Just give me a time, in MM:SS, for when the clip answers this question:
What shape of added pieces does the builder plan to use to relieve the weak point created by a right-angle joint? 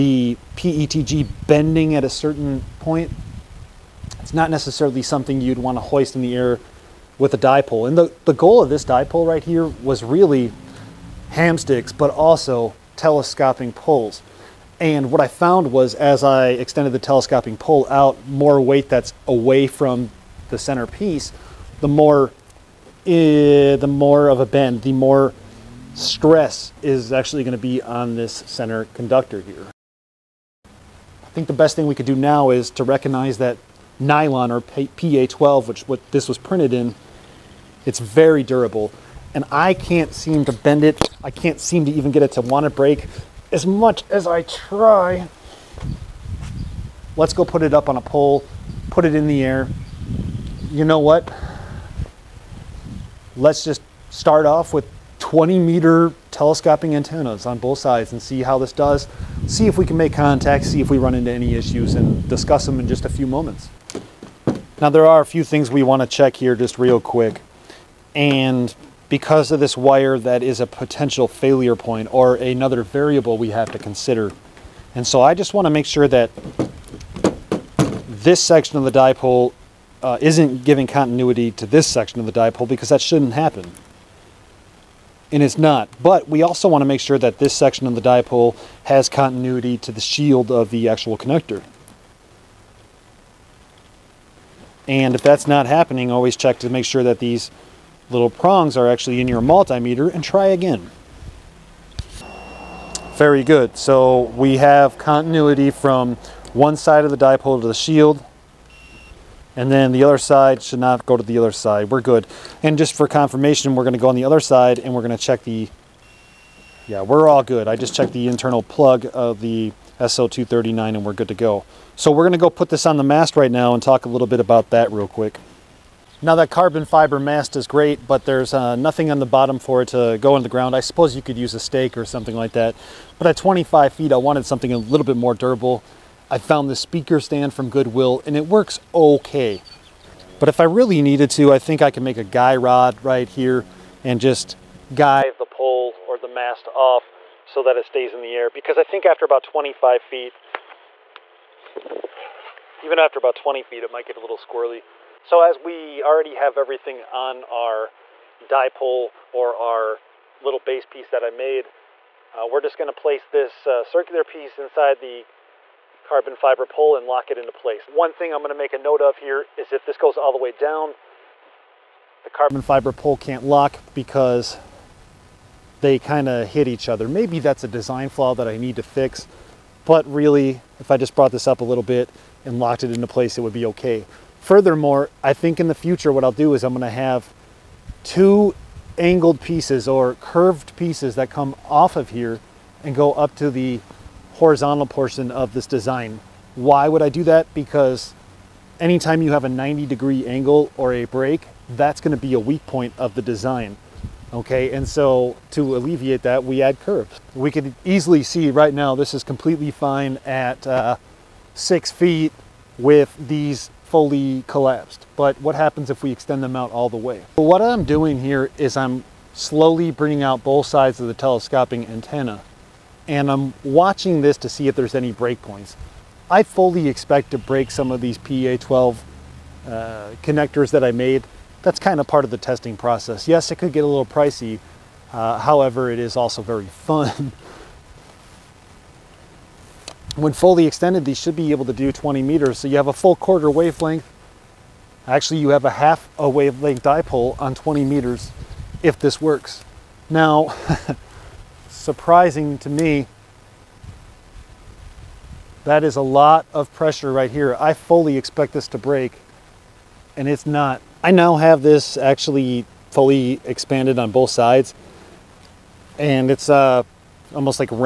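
03:26.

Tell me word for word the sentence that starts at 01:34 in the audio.
And if that's not happening, always check to make sure that these little prongs are actually in your multimeter and try again.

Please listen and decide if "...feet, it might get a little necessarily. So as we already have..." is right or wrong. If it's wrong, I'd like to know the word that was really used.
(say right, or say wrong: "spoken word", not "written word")
wrong: "squirrely", not "necessarily".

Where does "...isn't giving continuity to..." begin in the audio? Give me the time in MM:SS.
01:20.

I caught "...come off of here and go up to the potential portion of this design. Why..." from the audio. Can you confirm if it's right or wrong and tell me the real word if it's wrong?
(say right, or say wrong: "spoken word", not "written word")
wrong: "horizontal", not "potential".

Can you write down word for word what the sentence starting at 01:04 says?
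Now there are a few things we want to check here just real quick.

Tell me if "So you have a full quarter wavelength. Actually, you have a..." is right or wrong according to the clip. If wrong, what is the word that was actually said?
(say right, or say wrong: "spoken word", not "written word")
right.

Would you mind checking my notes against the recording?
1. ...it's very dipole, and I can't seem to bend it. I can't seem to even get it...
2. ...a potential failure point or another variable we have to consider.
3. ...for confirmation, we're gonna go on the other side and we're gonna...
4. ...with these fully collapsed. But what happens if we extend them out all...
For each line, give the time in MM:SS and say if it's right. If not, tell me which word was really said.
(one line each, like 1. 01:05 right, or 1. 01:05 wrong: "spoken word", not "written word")
1. 00:37 wrong: "durable", not "dipole"
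2. 01:10 right
3. 01:52 right
4. 03:32 right.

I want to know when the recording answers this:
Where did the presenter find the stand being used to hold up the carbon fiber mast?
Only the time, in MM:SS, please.
02:17.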